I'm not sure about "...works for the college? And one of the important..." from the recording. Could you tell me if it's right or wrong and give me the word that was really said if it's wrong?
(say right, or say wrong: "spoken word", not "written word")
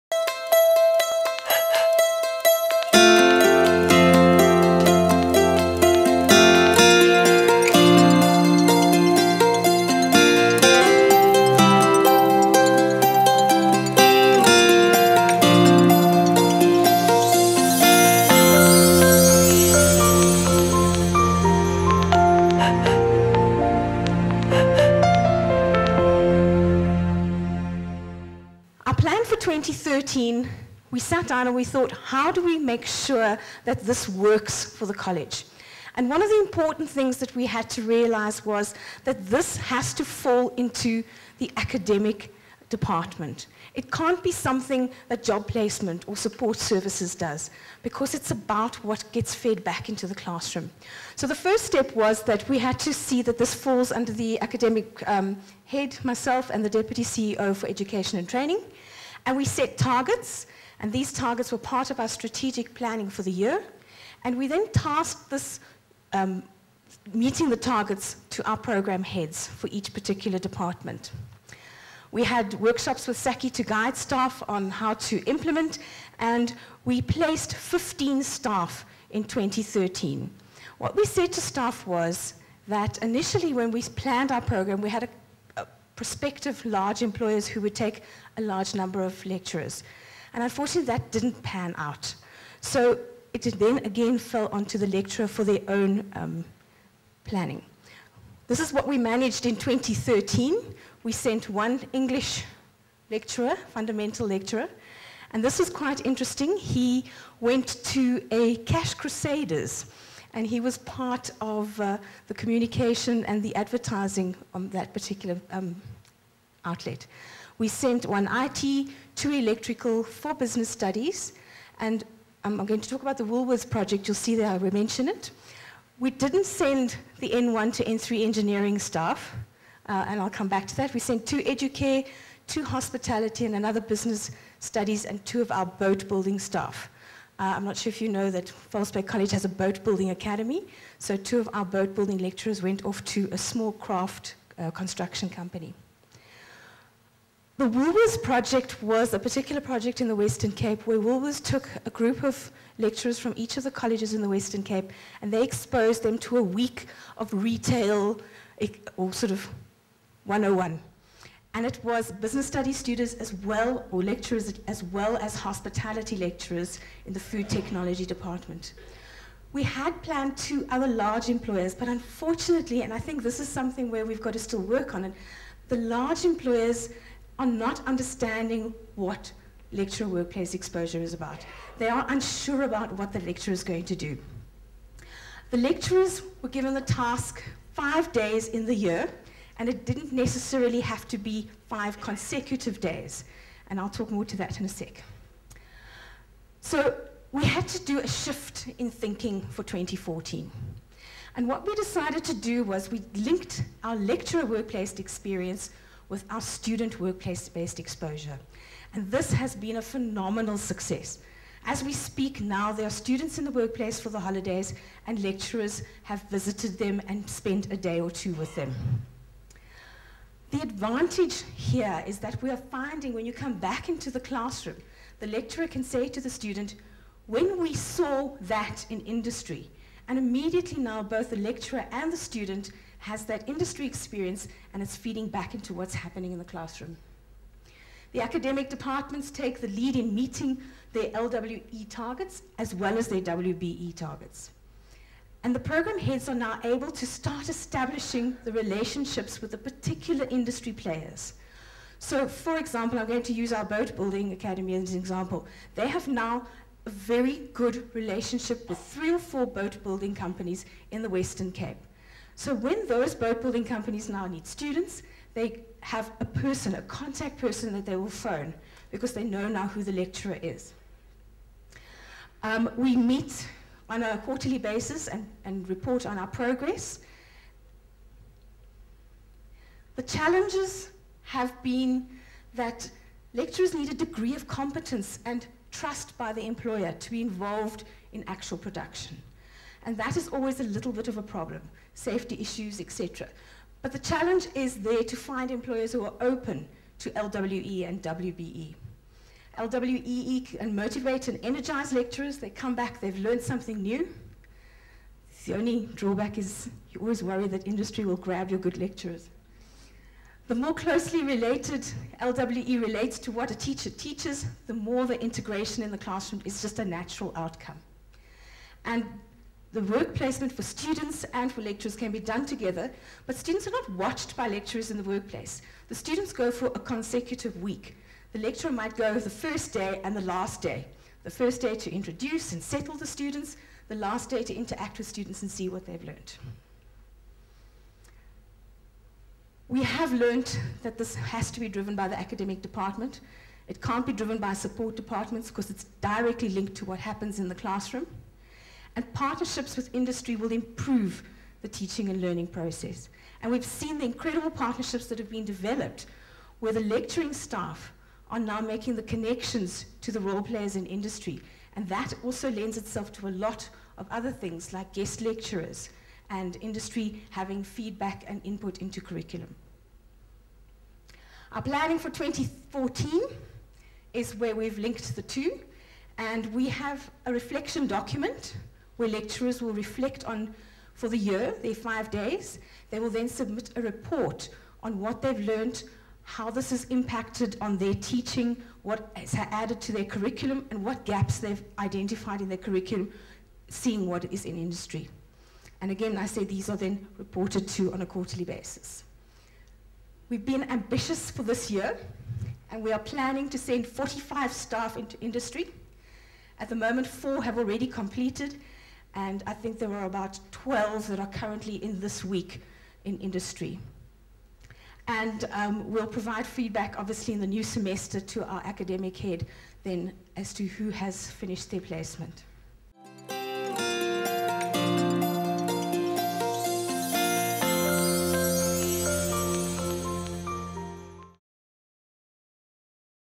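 right.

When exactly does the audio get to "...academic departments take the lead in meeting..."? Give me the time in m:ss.
3:58.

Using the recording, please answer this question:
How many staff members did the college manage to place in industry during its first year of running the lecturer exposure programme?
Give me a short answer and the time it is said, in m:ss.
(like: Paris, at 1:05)
15, at 1:17.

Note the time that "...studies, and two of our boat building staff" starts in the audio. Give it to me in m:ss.
2:14.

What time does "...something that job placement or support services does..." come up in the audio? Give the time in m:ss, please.
0:44.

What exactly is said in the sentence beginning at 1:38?
This is what we managed in 2013.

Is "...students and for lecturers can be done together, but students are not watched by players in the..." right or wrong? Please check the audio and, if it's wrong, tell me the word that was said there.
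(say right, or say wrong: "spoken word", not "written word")
wrong: "lecturers", not "players".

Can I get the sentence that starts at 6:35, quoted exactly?
And again, I say these are then reported to on a quarterly basis.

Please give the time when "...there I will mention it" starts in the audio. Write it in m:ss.
2:04.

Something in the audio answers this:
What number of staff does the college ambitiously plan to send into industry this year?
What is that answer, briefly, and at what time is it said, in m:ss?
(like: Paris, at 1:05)
45, at 6:43.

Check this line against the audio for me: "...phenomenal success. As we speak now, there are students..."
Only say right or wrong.
right.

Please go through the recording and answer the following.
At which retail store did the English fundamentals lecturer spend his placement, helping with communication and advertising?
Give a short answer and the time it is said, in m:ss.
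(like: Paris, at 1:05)
Cash Crusaders, at 1:48.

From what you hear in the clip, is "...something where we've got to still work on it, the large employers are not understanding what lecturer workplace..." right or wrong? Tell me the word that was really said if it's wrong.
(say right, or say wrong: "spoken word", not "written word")
right.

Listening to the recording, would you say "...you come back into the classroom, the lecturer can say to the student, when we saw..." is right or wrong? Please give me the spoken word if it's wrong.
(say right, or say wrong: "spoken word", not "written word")
right.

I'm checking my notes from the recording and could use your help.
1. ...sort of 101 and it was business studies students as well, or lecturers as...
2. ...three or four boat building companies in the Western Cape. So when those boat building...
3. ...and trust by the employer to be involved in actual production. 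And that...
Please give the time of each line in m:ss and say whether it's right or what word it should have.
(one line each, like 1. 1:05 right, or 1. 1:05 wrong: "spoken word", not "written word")
1. 2:39 right
2. 4:18 right
3. 4:45 right.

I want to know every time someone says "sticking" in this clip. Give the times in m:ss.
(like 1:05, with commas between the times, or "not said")
not said.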